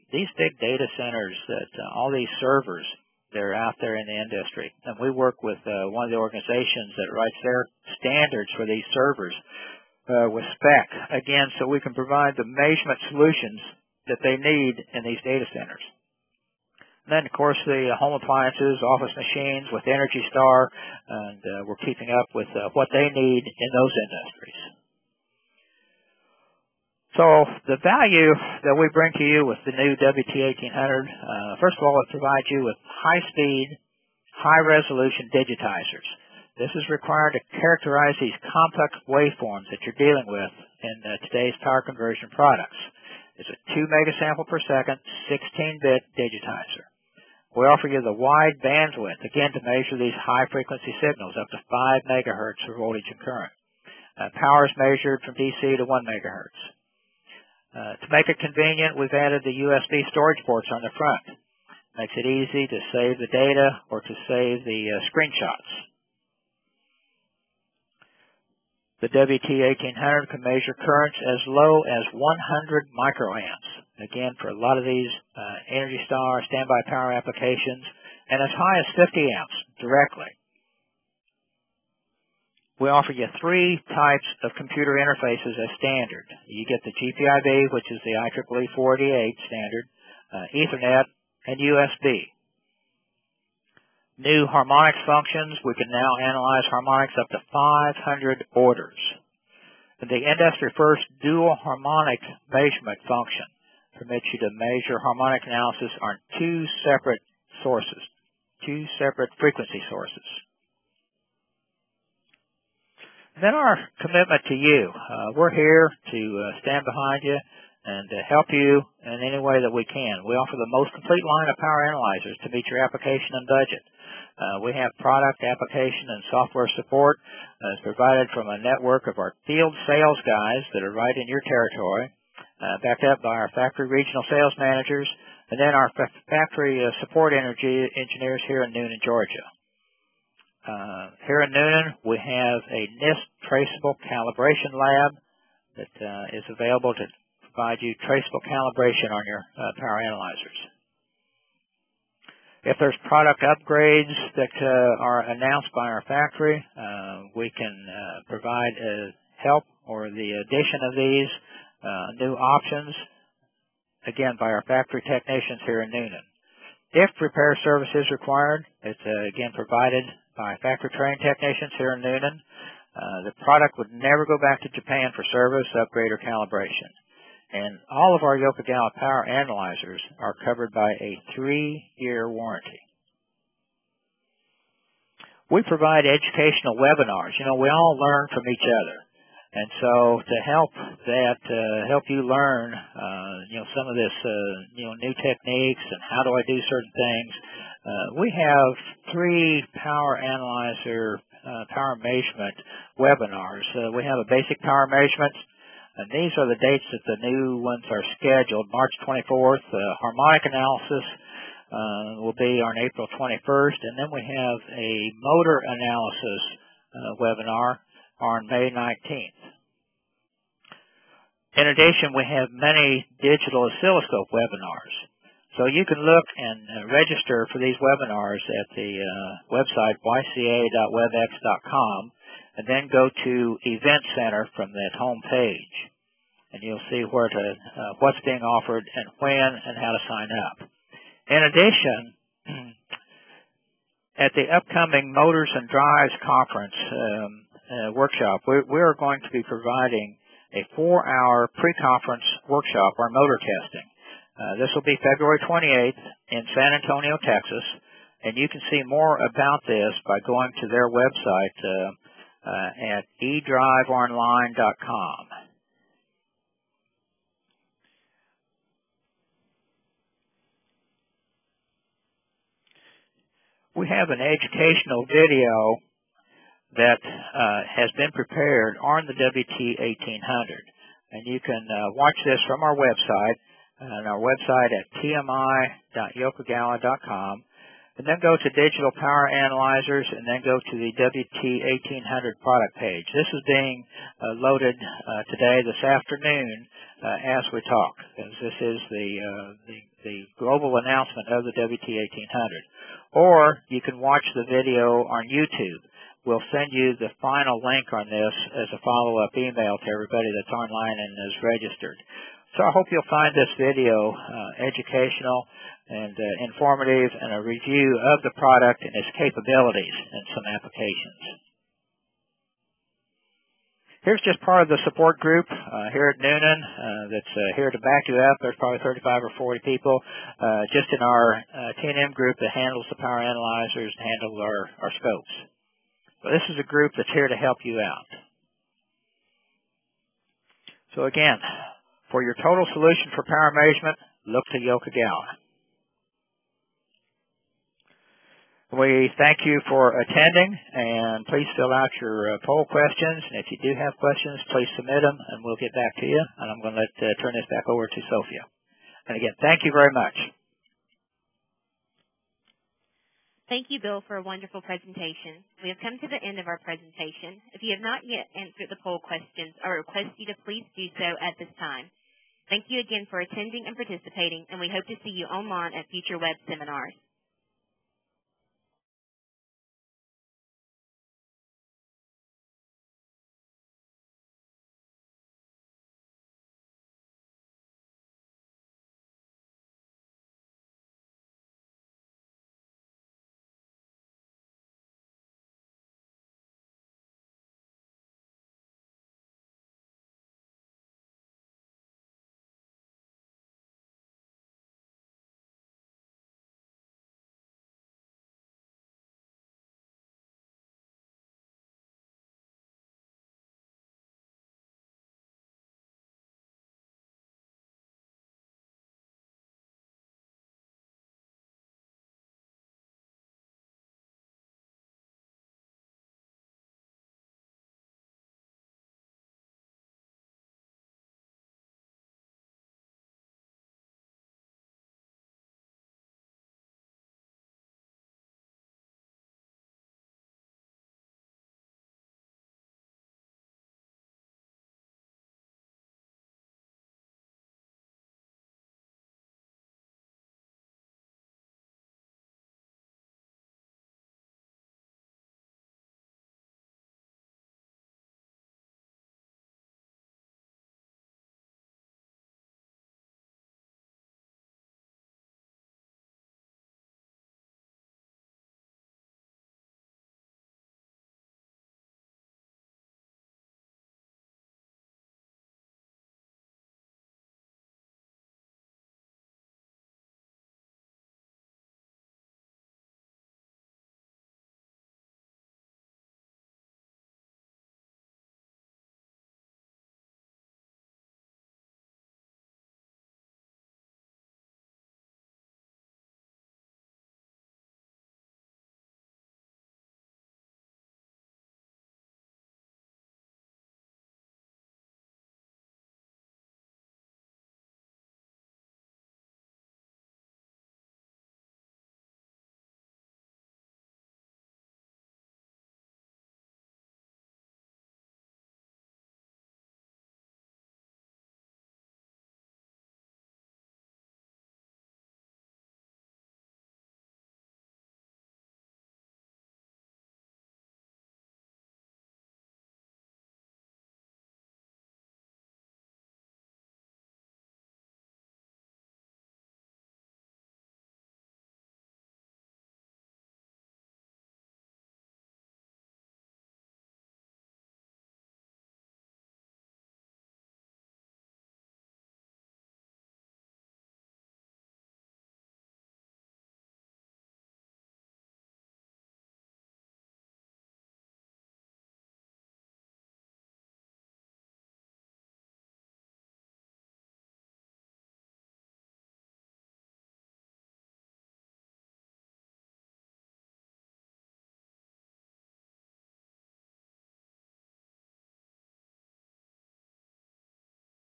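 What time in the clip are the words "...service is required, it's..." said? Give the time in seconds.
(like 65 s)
167 s.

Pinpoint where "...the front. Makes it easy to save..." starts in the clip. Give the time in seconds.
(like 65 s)
60 s.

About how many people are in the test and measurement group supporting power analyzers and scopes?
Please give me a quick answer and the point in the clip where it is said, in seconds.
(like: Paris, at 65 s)
35 or 40, at 328 s.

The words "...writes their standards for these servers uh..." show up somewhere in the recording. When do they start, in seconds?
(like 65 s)
7 s.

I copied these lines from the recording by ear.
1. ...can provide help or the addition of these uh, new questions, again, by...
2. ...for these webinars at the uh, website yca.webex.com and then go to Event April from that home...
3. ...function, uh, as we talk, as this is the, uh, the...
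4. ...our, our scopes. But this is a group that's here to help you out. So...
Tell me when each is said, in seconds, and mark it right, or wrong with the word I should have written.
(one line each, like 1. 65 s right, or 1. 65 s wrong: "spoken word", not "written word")
1. 157 s wrong: "options", not "questions"
2. 227 s wrong: "Center", not "April"
3. 295 s wrong: "afternoon", not "function"
4. 334 s right.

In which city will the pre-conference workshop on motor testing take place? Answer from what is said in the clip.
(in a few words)
San Antonio, Texas.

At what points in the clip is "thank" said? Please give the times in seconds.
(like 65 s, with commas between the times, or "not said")
349 s, 359 s, 363 s, 372 s.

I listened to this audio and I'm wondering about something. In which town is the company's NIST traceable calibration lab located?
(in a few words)
Newnan, Georgia.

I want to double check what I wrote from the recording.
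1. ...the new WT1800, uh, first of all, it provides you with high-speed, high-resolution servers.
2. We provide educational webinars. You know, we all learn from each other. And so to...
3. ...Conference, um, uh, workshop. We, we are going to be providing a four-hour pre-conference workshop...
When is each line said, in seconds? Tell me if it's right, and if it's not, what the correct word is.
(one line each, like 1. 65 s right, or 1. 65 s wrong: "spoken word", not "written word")
1. 29 s wrong: "digitizers", not "servers"
2. 185 s right
3. 246 s right.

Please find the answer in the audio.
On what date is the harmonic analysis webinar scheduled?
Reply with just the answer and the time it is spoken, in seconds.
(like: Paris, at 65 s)
April 21, at 212 s.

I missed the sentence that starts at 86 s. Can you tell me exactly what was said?
You get the GPIB, which is the IEEE 488 standard, uh, Ethernet, and USB.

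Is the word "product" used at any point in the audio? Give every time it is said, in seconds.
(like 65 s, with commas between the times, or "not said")
42 s, 124 s, 153 s, 173 s, 292 s, 318 s.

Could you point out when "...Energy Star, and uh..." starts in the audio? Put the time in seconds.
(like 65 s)
19 s.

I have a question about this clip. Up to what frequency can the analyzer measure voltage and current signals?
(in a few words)
5 MHz.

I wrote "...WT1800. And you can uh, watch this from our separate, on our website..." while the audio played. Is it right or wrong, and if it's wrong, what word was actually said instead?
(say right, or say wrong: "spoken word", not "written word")
wrong: "website", not "separate".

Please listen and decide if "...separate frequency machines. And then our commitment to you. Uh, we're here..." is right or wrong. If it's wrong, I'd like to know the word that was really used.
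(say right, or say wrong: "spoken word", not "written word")
wrong: "sources", not "machines".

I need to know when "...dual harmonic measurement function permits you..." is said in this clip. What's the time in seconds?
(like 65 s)
101 s.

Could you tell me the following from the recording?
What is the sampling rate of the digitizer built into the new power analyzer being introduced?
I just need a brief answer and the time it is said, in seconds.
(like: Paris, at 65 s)
2 megasamples per second, at 43 s.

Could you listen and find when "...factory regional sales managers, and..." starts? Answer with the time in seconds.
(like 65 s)
133 s.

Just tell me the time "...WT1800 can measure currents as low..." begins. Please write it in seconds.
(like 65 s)
69 s.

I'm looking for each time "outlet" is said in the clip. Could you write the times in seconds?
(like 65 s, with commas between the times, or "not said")
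not said.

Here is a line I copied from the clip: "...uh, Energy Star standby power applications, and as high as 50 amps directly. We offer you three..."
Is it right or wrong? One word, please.
right.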